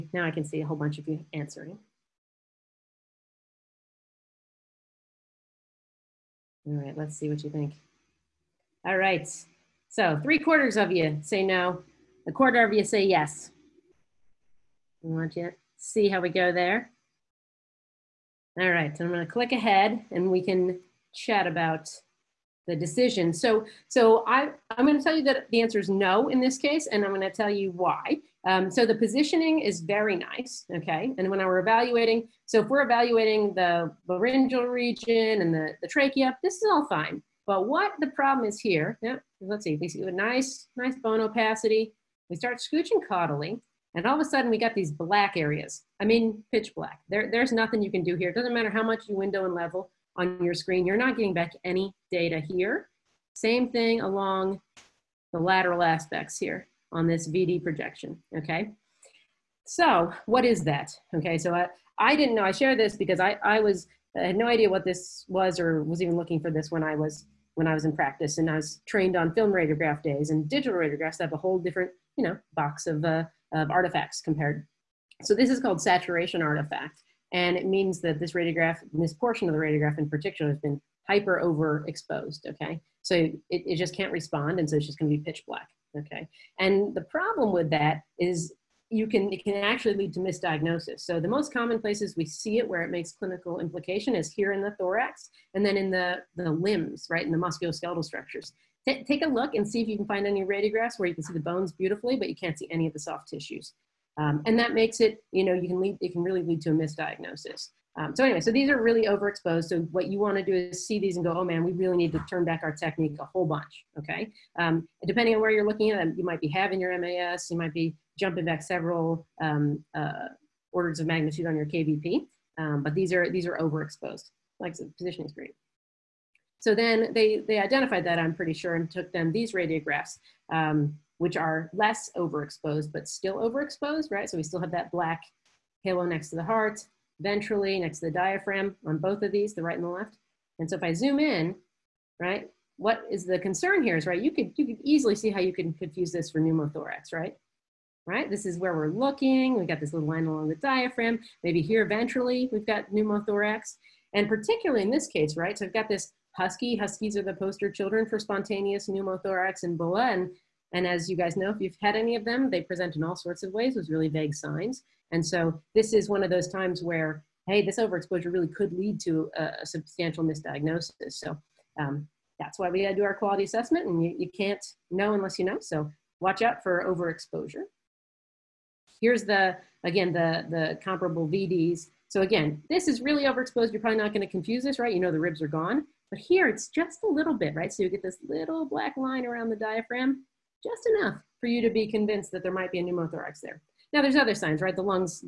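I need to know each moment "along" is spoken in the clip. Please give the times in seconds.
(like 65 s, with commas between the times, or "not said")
54 s, 150 s.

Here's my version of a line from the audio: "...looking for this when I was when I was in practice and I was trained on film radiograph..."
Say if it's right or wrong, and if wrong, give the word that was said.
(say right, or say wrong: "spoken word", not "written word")
right.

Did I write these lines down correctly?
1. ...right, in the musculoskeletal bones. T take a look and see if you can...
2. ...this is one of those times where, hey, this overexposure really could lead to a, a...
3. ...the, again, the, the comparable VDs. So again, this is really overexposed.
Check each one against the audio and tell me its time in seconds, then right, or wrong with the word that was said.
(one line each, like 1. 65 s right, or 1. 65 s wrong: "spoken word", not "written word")
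1. 97 s wrong: "structures", not "bones"
2. 165 s right
3. 179 s right.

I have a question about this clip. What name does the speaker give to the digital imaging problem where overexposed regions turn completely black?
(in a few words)
saturation artifact.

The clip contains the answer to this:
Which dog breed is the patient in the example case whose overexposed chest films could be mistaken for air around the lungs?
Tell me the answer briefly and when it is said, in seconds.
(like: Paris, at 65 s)
husky, at 156 s.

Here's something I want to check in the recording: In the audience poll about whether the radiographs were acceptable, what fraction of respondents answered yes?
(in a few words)
a quarter.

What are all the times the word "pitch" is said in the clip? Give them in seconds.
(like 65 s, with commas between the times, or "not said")
46 s, 85 s.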